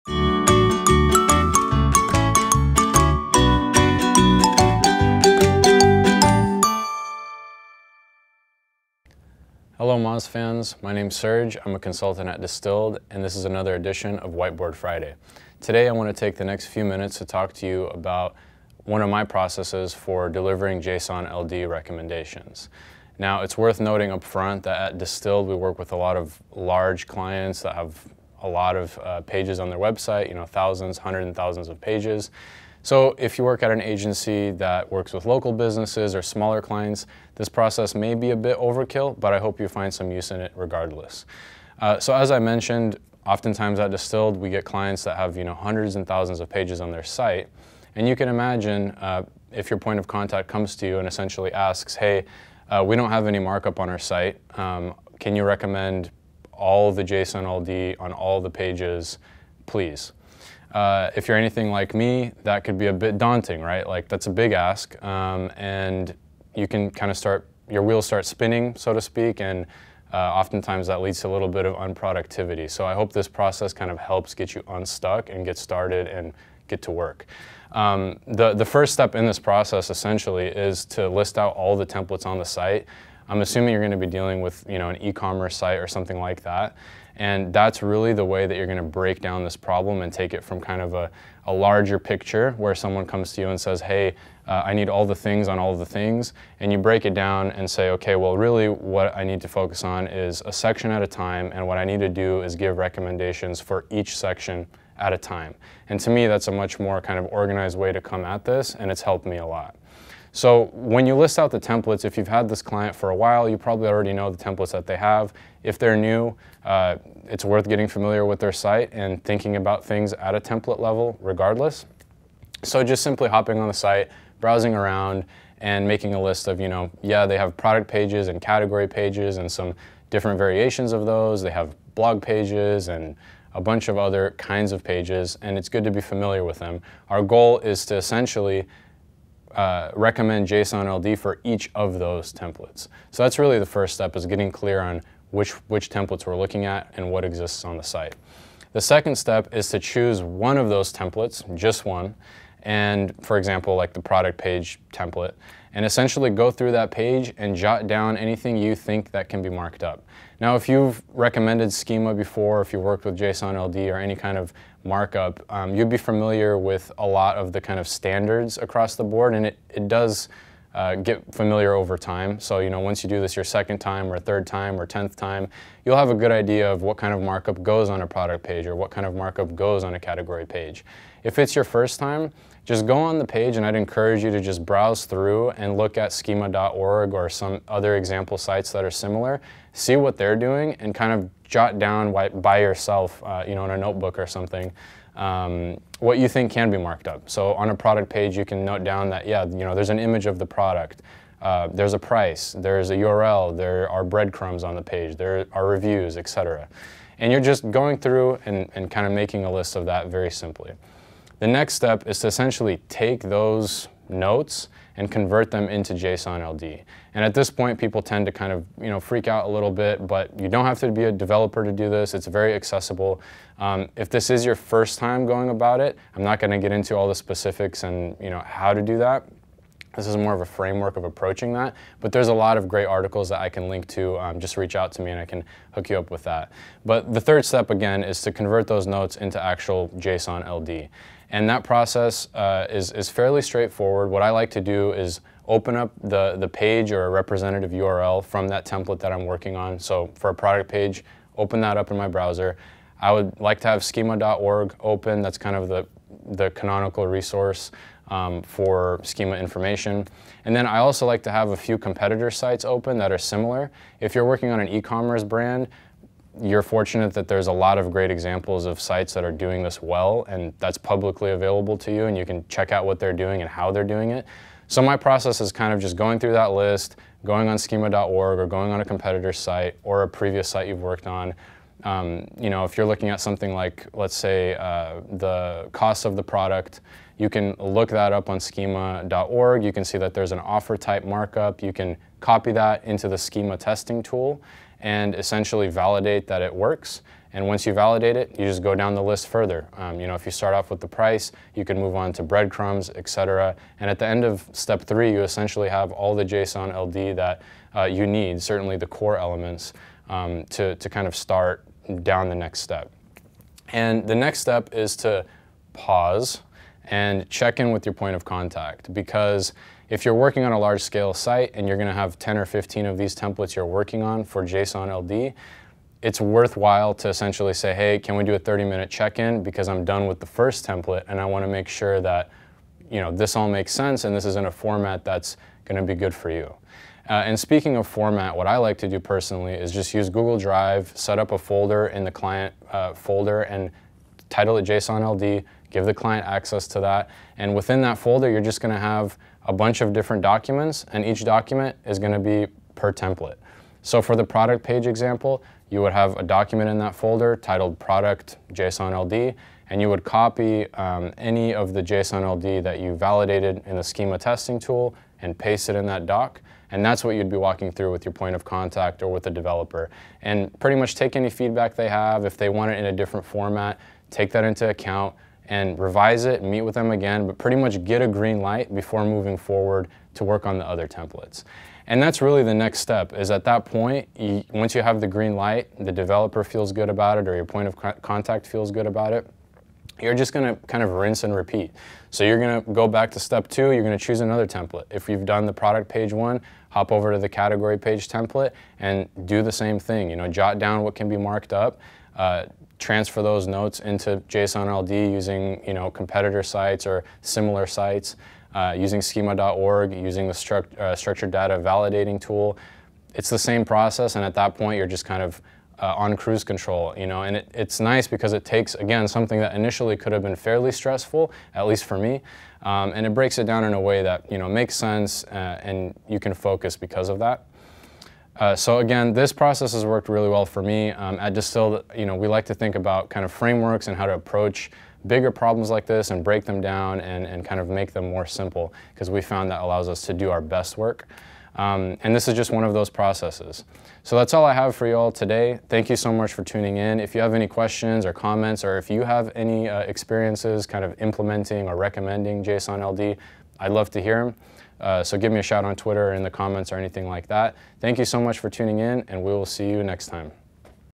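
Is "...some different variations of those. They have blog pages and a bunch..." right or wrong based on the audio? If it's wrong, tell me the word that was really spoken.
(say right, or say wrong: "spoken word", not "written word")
right.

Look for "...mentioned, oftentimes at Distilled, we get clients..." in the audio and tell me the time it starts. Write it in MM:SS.
00:42.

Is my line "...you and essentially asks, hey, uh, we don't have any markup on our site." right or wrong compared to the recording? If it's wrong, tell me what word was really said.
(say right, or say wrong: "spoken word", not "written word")
right.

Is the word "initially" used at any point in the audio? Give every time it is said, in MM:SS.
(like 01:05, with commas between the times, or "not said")
06:59.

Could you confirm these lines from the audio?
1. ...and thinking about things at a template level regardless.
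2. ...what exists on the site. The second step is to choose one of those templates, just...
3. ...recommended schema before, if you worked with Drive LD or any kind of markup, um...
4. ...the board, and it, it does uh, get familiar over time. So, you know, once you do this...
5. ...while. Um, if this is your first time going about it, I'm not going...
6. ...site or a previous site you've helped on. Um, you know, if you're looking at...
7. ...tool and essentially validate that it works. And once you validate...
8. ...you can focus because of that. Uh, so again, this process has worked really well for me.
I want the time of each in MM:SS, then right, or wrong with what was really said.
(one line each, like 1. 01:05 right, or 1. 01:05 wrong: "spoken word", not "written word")
1. 01:58 right
2. 02:27 right
3. 02:41 wrong: "JSON", not "Drive"
4. 02:48 right
5. 03:42 wrong: "accessible", not "while"
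6. 04:39 wrong: "worked", not "helped"
7. 04:54 right
8. 07:06 right.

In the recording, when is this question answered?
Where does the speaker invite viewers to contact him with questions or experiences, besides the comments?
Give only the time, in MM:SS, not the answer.
07:35.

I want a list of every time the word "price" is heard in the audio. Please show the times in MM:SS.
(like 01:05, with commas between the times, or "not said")
03:21, 05:00.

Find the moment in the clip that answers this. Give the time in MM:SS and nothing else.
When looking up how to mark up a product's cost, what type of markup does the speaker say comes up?
04:50.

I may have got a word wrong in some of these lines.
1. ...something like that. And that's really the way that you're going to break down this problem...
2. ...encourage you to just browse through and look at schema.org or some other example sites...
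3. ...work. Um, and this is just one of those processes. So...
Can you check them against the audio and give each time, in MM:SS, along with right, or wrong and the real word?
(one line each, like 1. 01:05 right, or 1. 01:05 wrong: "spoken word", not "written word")
1. 01:25 right
2. 03:03 right
3. 07:20 right.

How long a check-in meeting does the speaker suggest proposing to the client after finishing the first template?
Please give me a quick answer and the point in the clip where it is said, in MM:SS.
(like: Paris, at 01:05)
30 minutes, at 05:28.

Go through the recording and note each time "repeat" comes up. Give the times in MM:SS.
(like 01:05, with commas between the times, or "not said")
06:31.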